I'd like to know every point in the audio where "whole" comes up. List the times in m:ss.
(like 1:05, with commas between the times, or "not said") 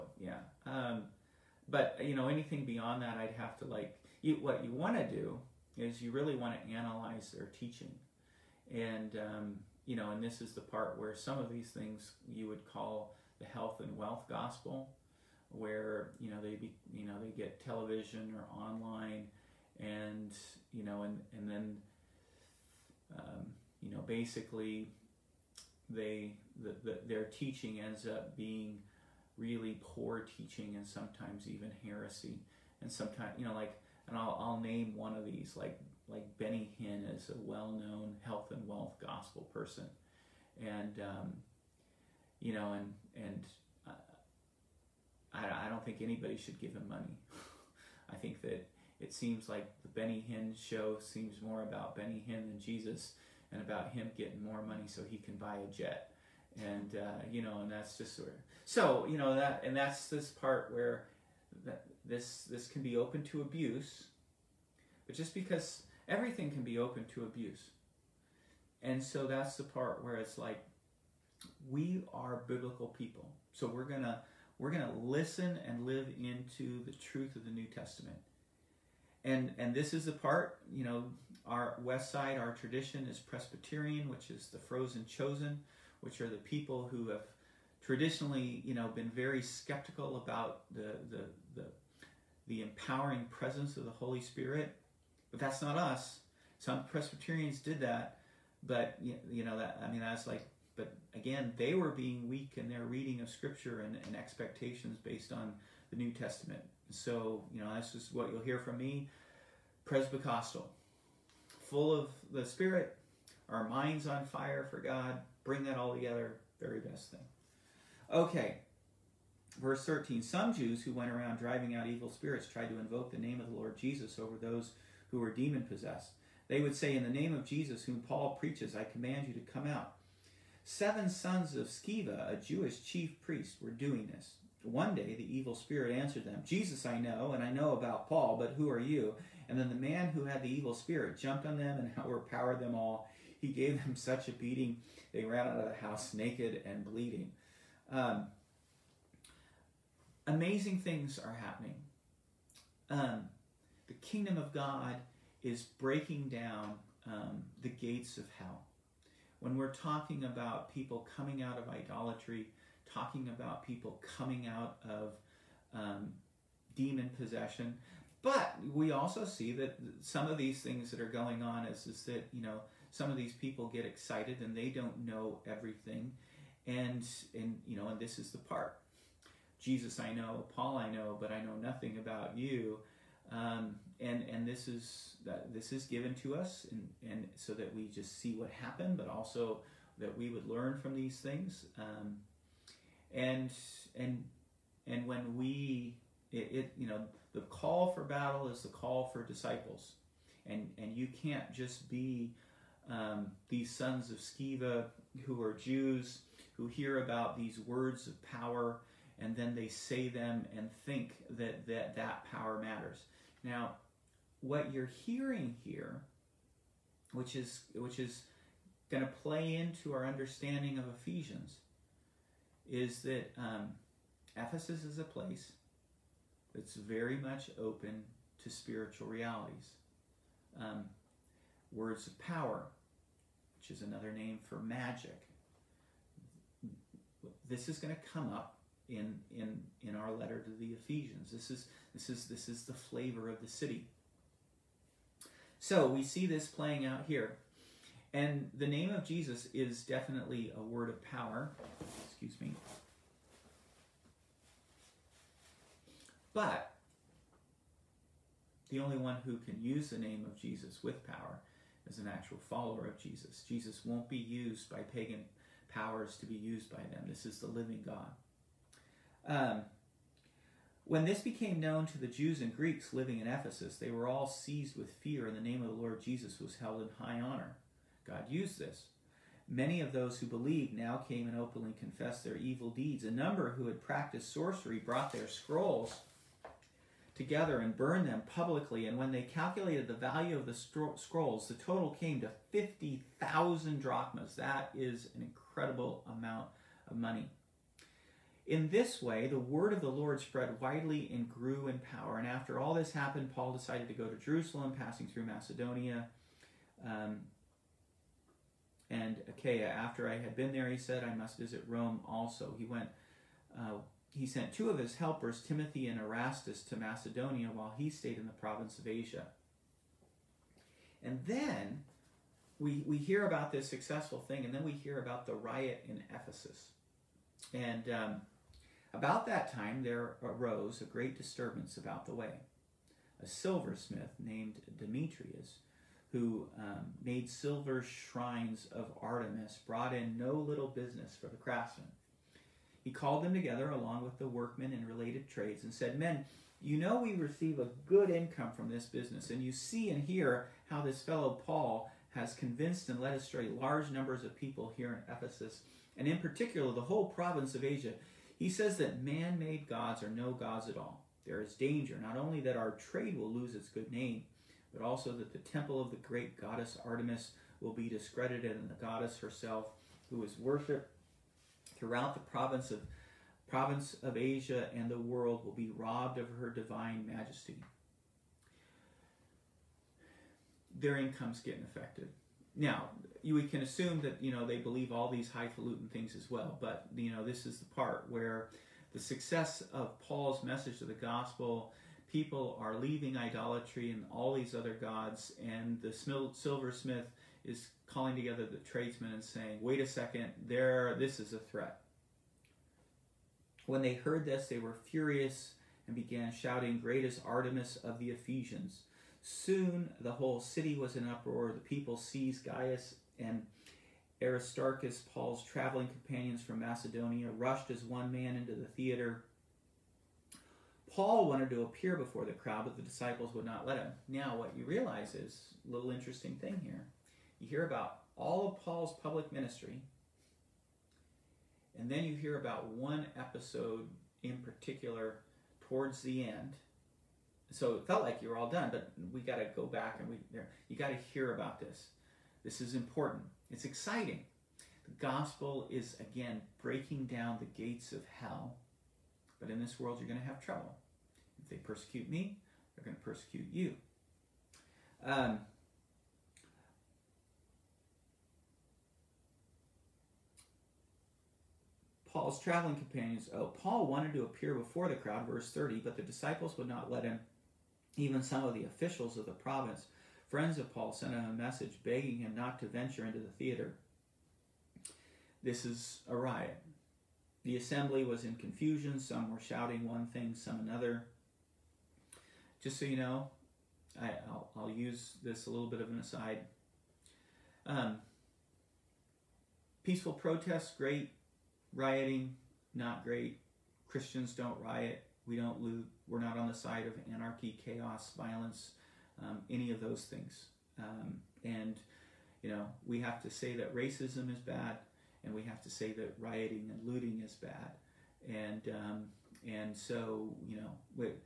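5:56, 6:50.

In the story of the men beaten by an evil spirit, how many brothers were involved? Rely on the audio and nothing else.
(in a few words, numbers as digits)
7.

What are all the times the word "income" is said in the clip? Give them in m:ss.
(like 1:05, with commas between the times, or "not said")
5:48, 6:20.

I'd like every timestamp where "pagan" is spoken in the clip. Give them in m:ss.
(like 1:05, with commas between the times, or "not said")
4:24.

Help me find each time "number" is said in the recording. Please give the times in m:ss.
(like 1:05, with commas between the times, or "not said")
4:43, 5:53.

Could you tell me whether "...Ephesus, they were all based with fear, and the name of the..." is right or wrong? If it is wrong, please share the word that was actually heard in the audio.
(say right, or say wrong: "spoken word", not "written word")
wrong: "seized", not "based".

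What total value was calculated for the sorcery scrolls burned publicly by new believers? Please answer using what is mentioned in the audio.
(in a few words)
50,000 drachmas.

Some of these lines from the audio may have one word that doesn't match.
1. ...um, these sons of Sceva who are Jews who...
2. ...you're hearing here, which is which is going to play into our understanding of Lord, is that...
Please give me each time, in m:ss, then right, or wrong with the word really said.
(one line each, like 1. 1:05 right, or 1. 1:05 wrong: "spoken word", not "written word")
1. 3:22 right
2. 3:34 wrong: "Ephesians", not "Lord".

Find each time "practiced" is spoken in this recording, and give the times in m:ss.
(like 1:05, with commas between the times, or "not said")
4:43.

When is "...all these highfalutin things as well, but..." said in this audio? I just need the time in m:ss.
6:24.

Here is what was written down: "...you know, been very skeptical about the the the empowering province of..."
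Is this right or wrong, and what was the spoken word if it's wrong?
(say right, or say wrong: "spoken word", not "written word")
wrong: "presence", not "province".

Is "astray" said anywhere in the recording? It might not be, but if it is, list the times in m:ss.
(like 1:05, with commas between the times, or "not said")
5:53.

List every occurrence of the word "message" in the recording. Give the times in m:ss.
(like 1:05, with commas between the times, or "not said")
6:30, 7:51.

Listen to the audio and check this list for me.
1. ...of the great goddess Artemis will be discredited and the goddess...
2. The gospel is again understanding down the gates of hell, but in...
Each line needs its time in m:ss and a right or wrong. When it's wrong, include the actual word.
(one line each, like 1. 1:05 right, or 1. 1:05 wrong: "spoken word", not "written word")
1. 6:05 right
2. 7:24 wrong: "breaking", not "understanding".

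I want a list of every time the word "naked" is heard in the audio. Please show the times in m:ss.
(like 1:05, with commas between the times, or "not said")
2:26.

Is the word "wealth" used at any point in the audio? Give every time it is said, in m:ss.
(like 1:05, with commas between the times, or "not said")
0:13, 0:38.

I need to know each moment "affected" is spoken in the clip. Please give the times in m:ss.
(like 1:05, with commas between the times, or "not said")
6:21.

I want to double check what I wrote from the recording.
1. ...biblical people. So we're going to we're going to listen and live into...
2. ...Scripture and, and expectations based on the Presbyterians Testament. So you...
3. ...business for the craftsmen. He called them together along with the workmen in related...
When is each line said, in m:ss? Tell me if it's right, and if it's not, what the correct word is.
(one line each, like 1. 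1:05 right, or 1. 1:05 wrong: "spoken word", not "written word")
1. 1:12 right
2. 1:43 wrong: "New", not "Presbyterians"
3. 5:40 right.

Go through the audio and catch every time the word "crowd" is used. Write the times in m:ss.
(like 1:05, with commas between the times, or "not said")
7:02, 7:44.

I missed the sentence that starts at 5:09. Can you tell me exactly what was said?
After I had been there, he said, I must visit Rome also.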